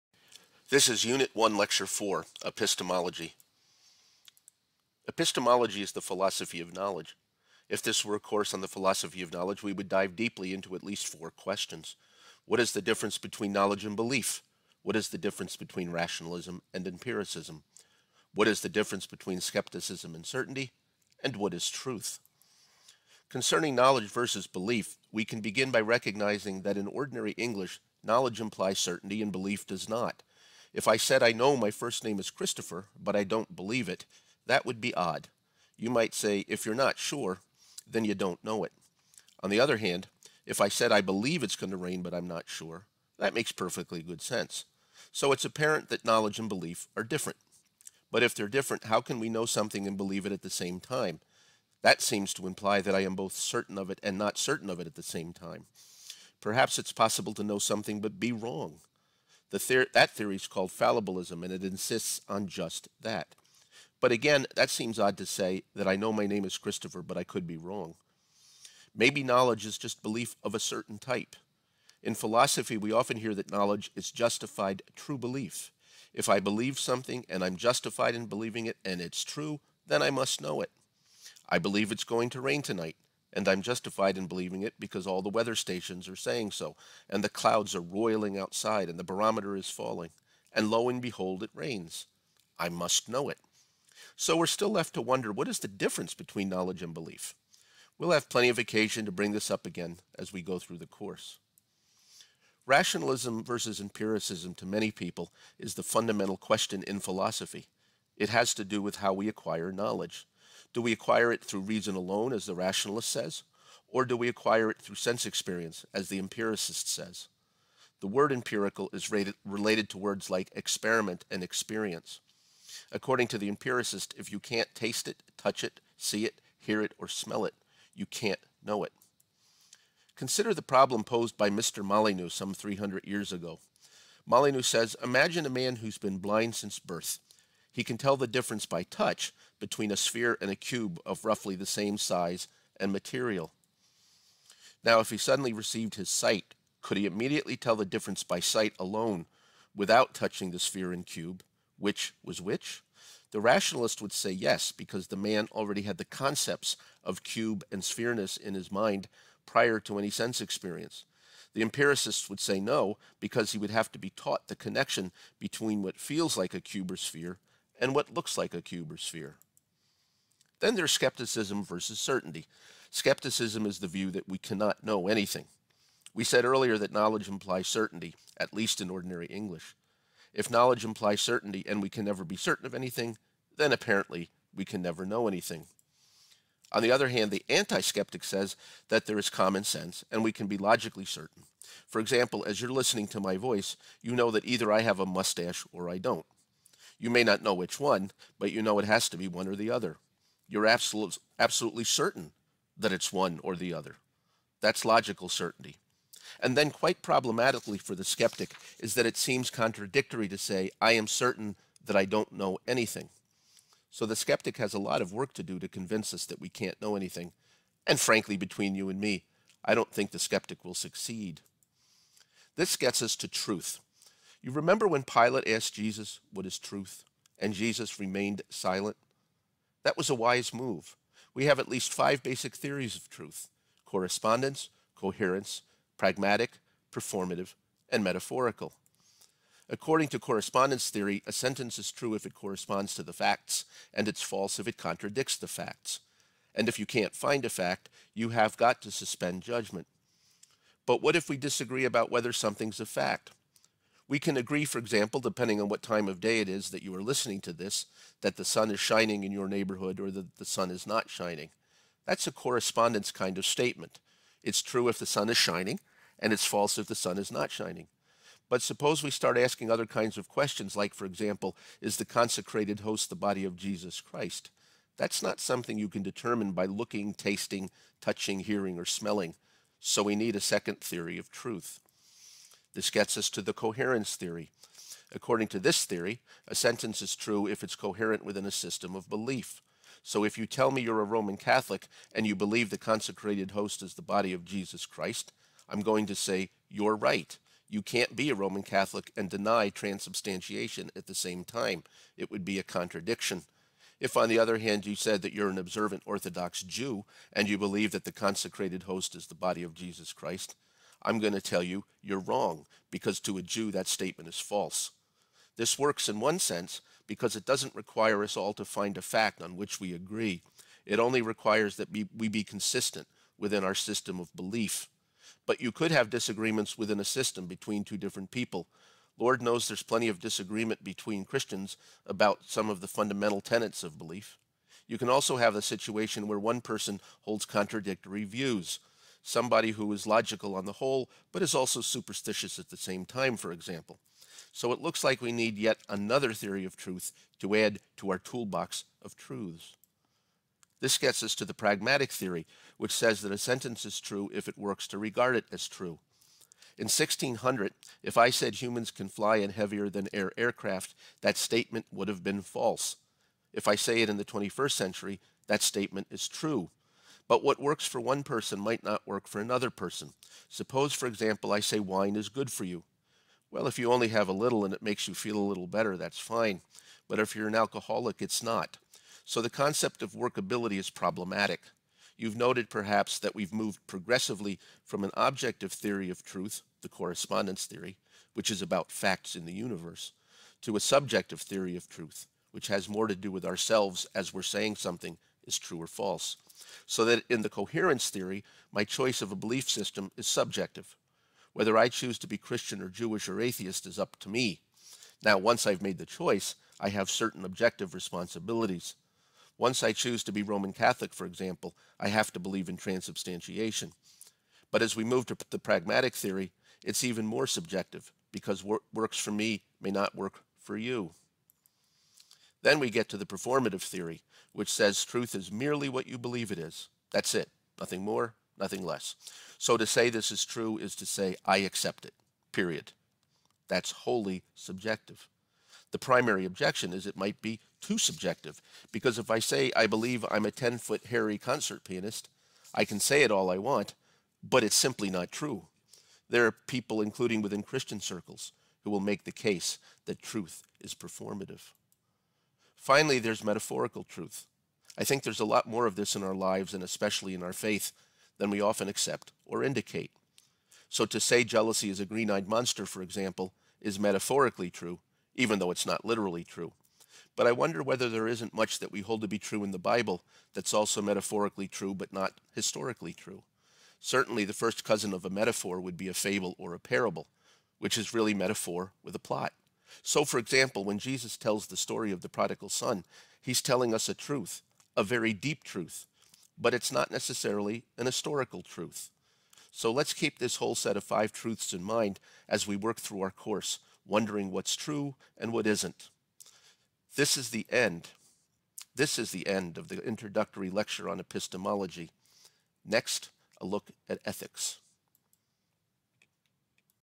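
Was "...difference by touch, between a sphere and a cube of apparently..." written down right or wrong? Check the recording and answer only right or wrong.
wrong.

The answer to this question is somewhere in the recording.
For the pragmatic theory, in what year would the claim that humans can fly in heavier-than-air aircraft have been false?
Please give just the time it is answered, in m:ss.
5:56.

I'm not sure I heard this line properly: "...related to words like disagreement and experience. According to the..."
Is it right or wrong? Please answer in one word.
wrong.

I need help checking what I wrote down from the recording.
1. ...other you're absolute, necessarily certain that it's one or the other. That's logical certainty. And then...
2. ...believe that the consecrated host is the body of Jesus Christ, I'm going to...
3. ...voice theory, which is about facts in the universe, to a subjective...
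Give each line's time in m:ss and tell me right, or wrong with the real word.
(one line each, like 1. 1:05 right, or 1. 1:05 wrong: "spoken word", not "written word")
1. 3:19 wrong: "absolutely", not "necessarily"
2. 5:07 right
3. 6:26 wrong: "correspondence", not "voice".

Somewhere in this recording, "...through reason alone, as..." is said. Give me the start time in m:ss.
1:51.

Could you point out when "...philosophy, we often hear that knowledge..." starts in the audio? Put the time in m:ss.
1:12.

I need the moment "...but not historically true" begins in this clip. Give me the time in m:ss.
7:51.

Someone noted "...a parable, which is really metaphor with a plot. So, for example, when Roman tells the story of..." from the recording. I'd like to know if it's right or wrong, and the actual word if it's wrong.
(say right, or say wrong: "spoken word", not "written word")
wrong: "Jesus", not "Roman".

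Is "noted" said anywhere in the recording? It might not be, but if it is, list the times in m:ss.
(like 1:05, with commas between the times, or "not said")
6:22.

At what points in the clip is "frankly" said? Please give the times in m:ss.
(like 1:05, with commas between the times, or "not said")
3:37.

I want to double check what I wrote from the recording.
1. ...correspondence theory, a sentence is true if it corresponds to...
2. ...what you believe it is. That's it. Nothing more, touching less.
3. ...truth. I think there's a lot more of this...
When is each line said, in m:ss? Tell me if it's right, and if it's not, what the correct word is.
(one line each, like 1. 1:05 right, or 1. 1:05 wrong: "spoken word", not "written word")
1. 4:00 right
2. 7:05 wrong: "nothing", not "touching"
3. 7:34 right.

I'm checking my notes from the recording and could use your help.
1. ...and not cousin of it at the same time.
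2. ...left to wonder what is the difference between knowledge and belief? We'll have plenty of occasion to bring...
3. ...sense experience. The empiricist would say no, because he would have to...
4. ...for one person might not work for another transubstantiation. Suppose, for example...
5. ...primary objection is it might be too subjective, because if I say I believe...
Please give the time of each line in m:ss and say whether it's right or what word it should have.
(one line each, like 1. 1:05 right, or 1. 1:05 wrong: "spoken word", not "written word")
1. 0:54 wrong: "certain", not "cousin"
2. 1:34 right
3. 2:40 right
4. 6:07 wrong: "person", not "transubstantiation"
5. 7:15 right.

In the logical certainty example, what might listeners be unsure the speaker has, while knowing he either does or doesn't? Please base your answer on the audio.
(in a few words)
a mustache.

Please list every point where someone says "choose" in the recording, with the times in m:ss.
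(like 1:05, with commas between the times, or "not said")
6:41, 6:49.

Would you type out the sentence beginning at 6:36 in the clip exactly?
So that in the coherence theory, my choice of a belief system is subjective.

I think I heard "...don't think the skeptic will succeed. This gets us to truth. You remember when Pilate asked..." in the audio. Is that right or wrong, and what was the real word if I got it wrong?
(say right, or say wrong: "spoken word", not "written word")
right.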